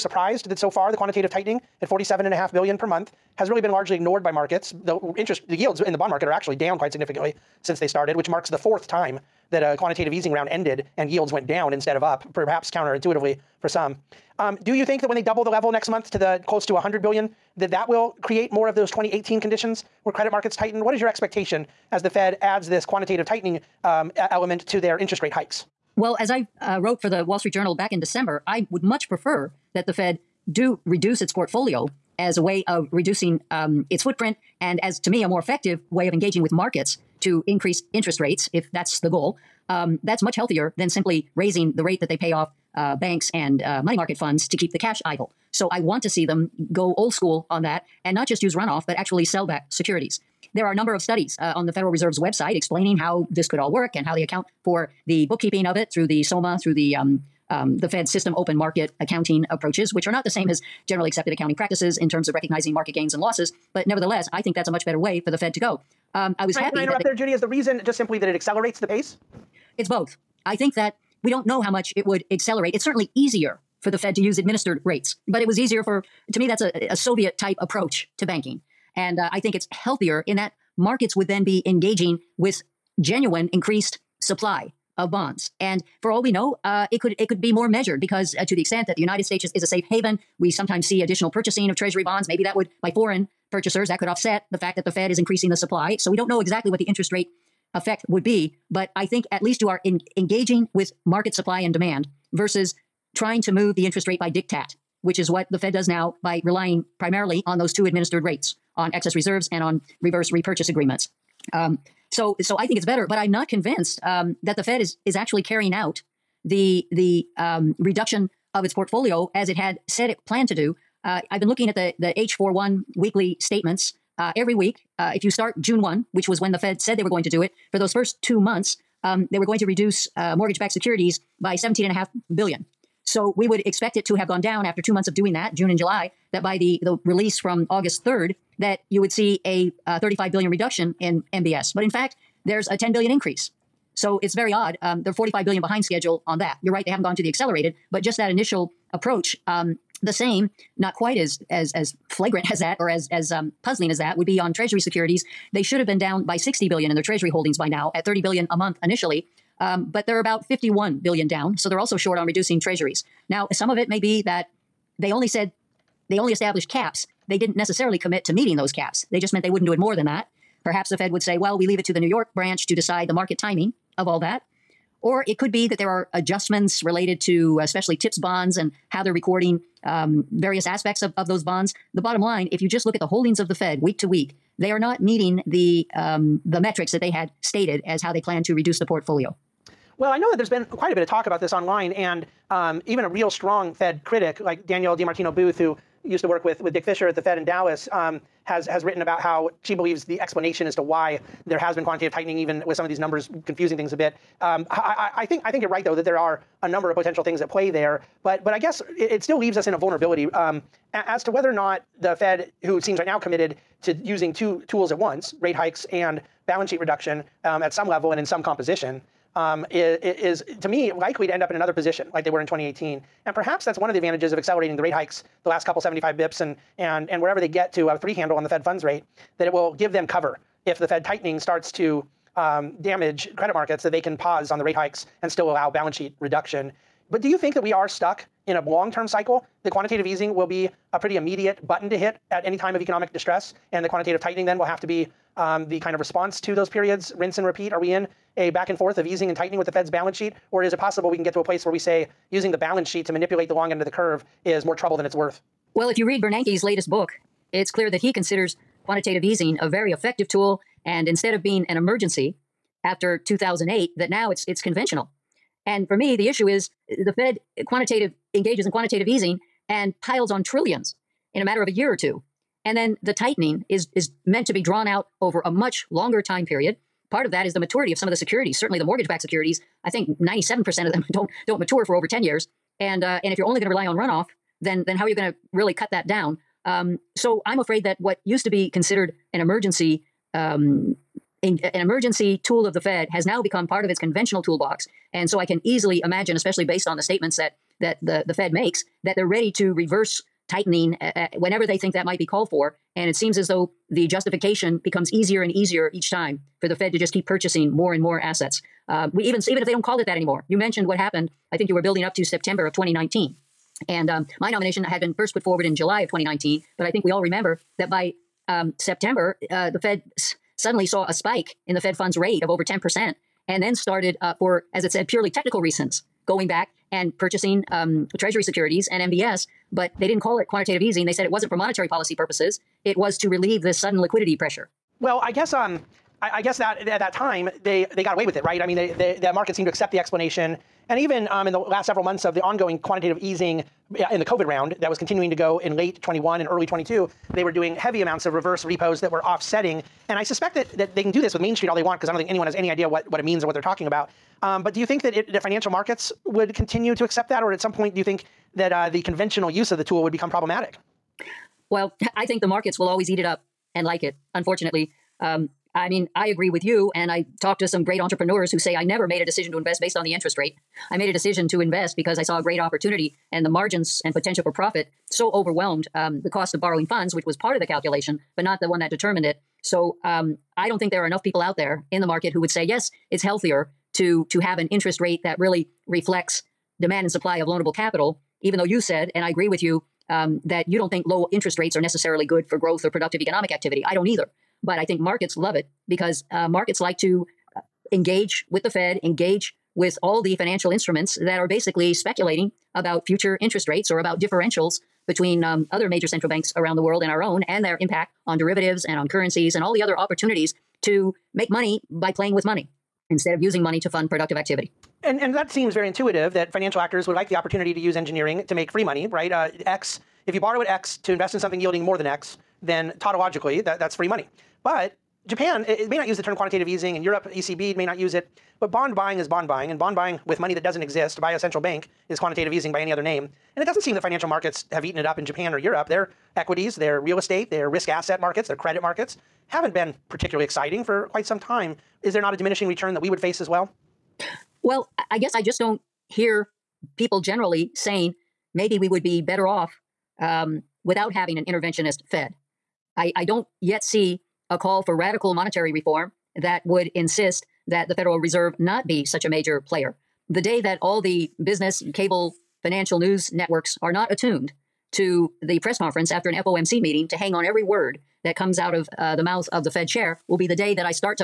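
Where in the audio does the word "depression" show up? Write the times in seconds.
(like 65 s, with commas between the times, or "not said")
not said.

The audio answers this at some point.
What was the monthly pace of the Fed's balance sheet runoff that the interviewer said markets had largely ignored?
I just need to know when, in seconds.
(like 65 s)
1 s.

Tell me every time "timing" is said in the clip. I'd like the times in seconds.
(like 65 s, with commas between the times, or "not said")
173 s.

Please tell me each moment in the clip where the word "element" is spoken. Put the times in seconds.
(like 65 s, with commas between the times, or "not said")
24 s.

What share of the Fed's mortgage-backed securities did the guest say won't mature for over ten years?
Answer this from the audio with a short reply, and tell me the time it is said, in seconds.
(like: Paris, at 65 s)
97%, at 280 s.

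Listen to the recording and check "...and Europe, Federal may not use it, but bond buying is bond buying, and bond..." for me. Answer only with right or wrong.
wrong.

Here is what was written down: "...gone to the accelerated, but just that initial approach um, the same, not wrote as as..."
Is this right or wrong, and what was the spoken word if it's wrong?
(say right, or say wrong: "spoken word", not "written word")
wrong: "quite", not "wrote".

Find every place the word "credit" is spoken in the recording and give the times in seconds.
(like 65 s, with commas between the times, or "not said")
20 s, 233 s, 438 s.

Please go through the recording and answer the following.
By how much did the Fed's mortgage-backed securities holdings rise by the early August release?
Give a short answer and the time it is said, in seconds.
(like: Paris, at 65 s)
10 billion, at 142 s.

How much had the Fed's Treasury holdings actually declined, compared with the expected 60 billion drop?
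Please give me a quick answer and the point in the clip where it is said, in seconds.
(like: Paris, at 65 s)
51 billion, at 160 s.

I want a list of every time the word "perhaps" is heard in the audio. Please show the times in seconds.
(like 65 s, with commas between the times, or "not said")
12 s, 170 s, 223 s.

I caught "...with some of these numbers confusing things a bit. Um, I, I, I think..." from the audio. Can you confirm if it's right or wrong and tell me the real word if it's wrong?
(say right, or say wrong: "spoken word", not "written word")
right.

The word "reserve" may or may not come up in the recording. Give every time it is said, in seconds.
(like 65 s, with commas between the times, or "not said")
51 s, 109 s, 458 s.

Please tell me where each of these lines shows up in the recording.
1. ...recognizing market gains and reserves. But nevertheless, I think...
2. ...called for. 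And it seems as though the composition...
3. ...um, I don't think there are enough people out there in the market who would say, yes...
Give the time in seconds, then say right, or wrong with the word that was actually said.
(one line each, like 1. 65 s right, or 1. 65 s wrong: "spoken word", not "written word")
1. 62 s wrong: "losses", not "reserves"
2. 302 s wrong: "justification", not "composition"
3. 380 s right.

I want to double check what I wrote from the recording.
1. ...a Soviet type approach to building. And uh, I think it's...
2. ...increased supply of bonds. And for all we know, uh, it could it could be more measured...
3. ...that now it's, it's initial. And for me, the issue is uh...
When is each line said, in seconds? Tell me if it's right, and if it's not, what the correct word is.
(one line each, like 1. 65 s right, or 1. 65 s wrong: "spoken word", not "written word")
1. 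76 s wrong: "banking", not "building"
2. 83 s right
3. 263 s wrong: "conventional", not "initial".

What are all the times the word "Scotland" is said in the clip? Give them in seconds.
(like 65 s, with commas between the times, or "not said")
not said.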